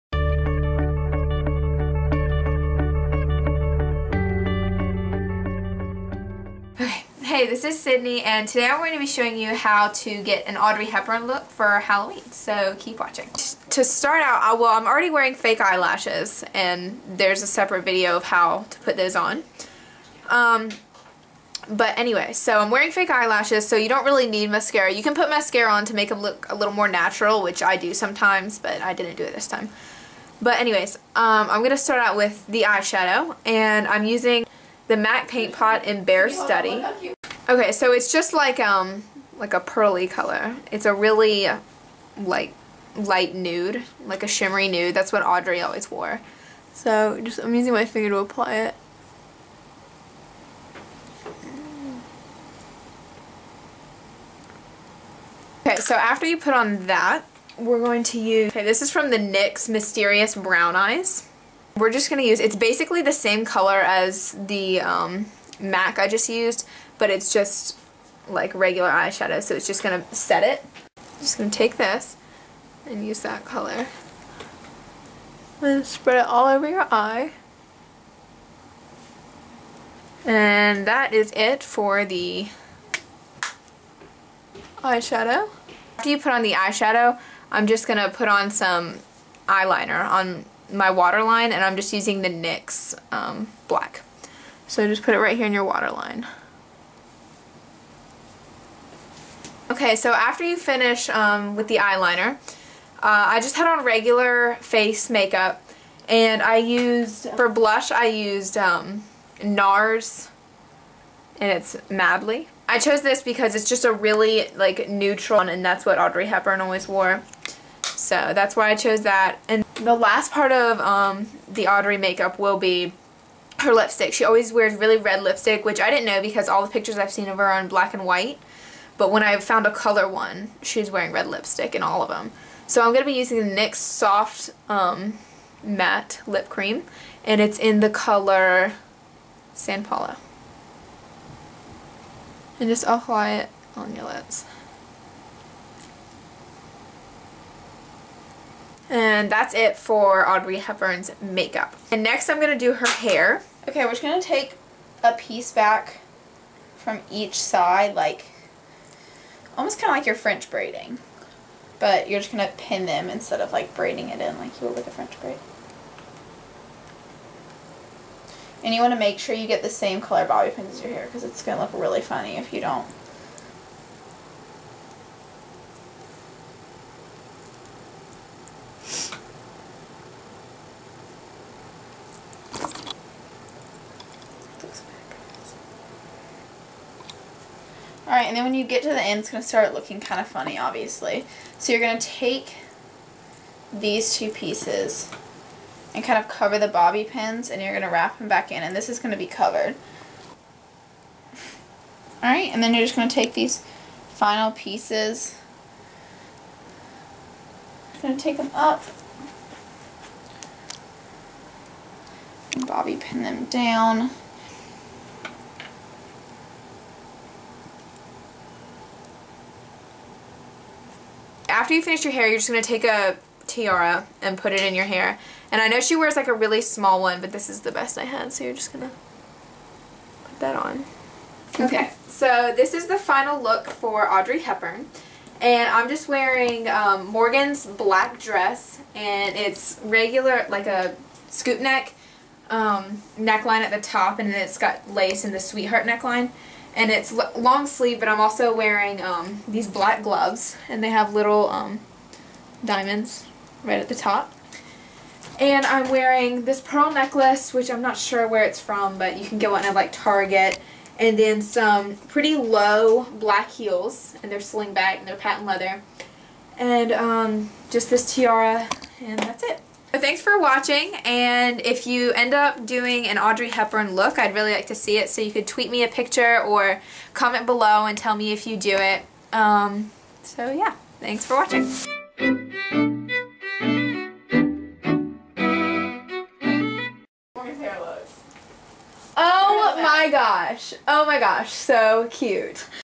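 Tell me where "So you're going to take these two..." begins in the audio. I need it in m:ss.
3:11.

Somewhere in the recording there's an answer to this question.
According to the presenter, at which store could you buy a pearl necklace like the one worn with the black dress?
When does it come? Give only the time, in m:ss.
4:19.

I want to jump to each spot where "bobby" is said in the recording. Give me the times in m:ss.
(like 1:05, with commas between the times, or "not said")
2:50, 3:16, 3:32.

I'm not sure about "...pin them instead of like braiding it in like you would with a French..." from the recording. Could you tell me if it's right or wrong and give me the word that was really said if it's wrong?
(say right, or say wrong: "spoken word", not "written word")
right.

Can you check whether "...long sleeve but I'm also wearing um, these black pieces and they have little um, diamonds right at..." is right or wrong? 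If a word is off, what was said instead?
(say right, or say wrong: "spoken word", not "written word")
wrong: "gloves", not "pieces".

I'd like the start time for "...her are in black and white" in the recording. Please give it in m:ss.
2:07.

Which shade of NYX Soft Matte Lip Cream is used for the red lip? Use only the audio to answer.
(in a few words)
San Paulo.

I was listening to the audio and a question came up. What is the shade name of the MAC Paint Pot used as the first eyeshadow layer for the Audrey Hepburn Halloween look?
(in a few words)
Bare Study.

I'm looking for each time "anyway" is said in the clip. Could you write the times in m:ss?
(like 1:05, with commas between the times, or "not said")
0:21, 0:30.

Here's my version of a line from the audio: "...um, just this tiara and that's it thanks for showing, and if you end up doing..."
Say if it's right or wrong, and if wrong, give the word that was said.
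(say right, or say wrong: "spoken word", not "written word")
wrong: "watching", not "showing".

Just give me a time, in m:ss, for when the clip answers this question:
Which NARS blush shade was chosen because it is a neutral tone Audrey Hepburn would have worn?
1:51.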